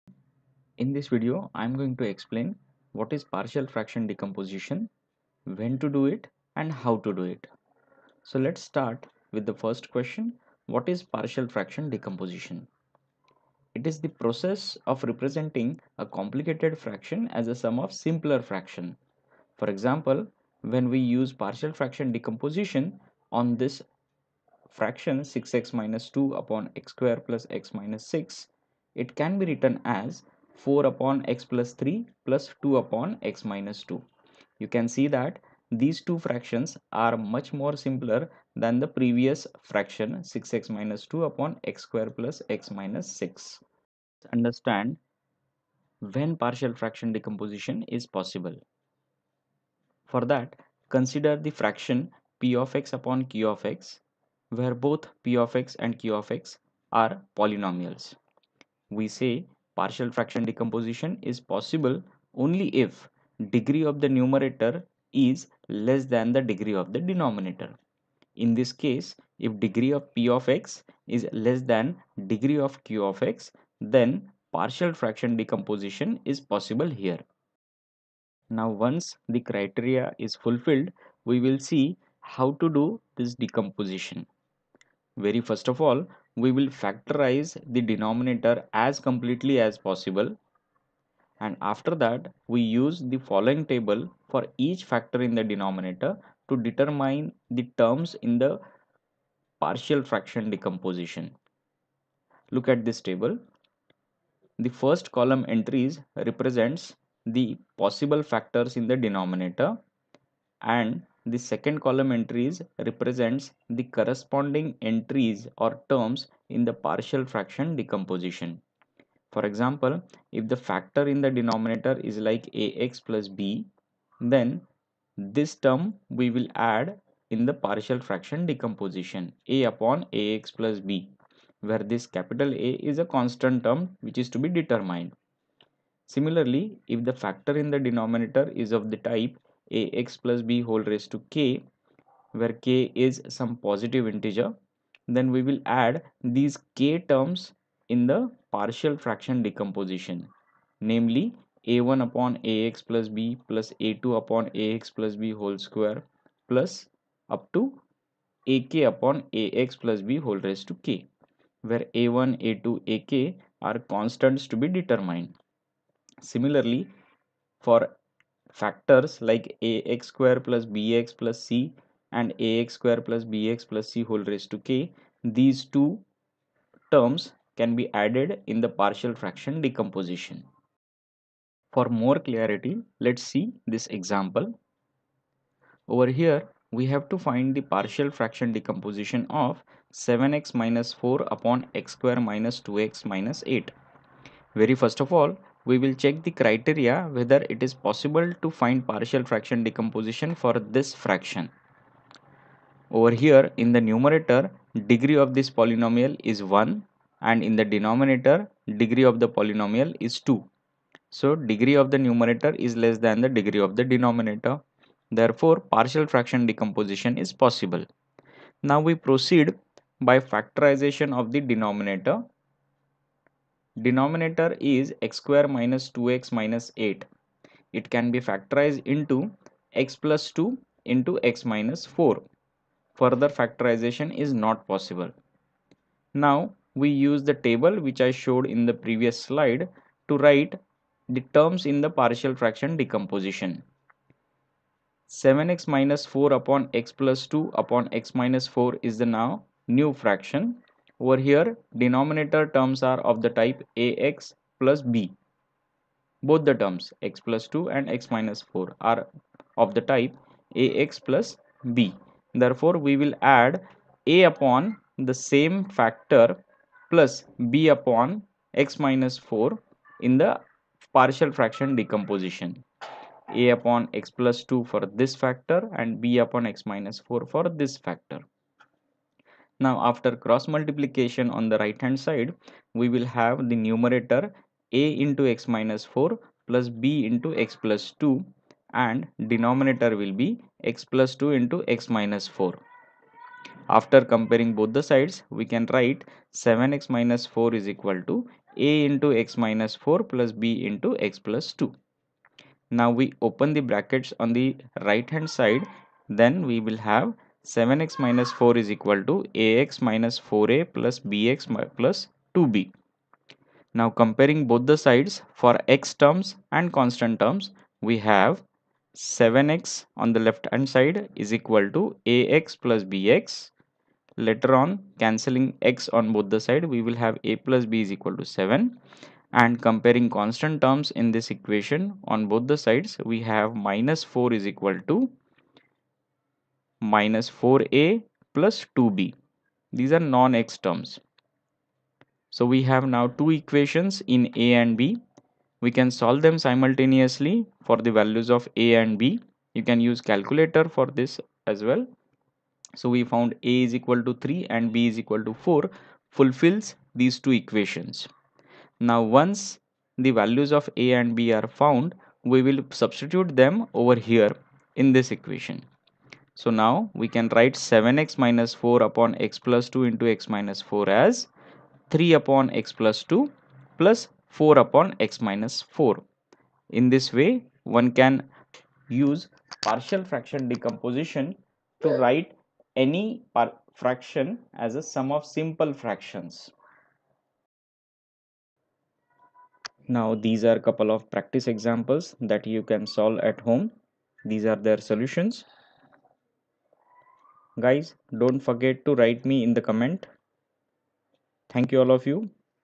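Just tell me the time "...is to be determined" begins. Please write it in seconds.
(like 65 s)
134 s.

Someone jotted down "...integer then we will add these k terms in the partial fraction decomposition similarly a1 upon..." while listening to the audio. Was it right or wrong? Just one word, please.
wrong.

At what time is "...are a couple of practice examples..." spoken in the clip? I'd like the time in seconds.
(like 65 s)
390 s.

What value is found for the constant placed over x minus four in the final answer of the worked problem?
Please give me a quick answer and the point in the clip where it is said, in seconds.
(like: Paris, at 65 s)
4, at 354 s.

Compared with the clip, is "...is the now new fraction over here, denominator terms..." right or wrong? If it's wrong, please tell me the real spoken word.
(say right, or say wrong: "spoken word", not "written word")
right.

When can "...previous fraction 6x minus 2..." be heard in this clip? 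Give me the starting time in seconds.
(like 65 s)
38 s.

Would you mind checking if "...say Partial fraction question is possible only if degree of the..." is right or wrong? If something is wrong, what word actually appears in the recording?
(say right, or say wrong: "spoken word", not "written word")
wrong: "decomposition", not "question".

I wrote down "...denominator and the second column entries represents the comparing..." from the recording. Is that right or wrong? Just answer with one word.
wrong.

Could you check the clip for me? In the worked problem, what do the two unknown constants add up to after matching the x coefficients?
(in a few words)
7.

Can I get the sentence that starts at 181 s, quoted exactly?
For more clarity, let's see this example.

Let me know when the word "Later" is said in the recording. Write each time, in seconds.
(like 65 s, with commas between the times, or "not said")
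324 s.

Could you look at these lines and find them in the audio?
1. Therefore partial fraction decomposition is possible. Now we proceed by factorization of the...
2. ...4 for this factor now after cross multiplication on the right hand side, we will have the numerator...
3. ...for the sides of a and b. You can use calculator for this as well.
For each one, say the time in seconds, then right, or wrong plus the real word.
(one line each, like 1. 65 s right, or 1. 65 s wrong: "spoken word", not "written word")
1. 215 s right
2. 276 s right
3. 347 s wrong: "values", not "sides".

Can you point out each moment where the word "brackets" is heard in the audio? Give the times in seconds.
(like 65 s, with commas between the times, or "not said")
303 s.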